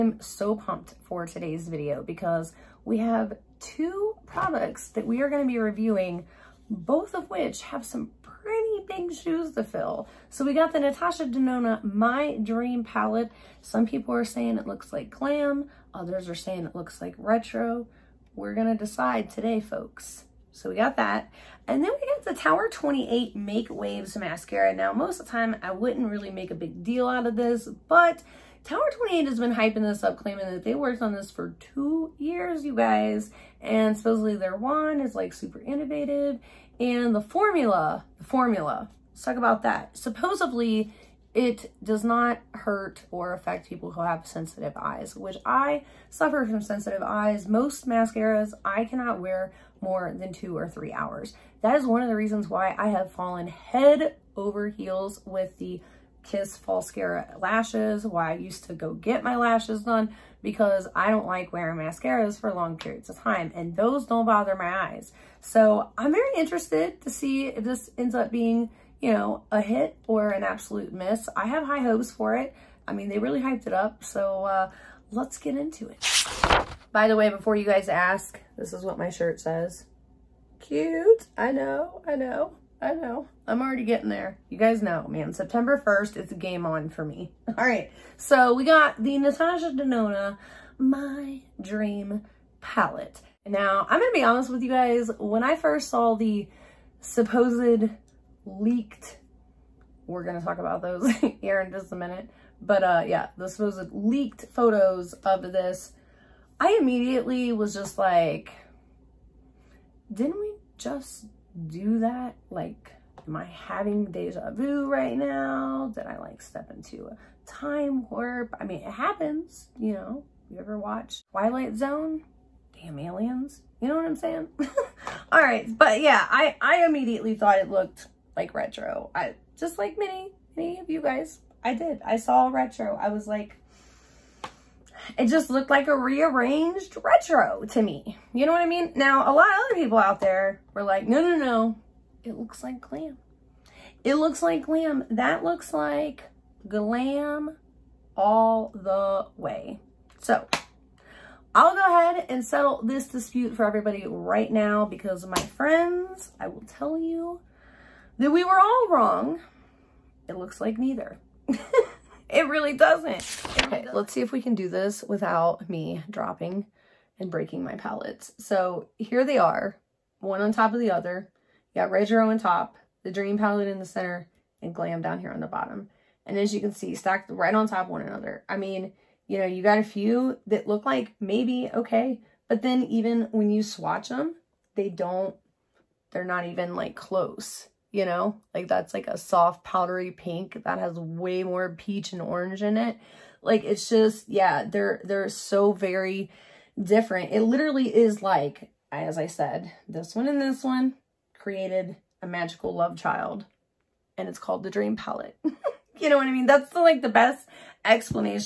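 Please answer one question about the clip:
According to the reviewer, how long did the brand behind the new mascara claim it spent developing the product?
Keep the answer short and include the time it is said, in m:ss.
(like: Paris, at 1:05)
2 years, at 0:31.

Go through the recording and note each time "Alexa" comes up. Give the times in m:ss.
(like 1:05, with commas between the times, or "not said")
not said.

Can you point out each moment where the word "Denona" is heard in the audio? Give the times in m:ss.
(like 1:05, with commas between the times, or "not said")
0:11, 1:29.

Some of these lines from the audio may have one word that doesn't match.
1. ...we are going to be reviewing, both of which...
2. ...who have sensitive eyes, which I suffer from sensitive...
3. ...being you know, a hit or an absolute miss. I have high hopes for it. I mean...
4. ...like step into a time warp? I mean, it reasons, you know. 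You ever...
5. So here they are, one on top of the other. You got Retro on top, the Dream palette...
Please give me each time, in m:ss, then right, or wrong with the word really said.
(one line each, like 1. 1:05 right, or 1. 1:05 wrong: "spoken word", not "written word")
1. 0:05 right
2. 0:43 right
3. 1:08 right
4. 1:56 wrong: "happens", not "reasons"
5. 2:48 right.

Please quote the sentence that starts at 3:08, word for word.
Like that's like a soft powdery pink that has way more peach and orange in it.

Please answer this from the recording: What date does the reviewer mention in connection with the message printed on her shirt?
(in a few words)
September 1st.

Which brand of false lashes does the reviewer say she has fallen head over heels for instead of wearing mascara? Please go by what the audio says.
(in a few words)
Kiss Falscara.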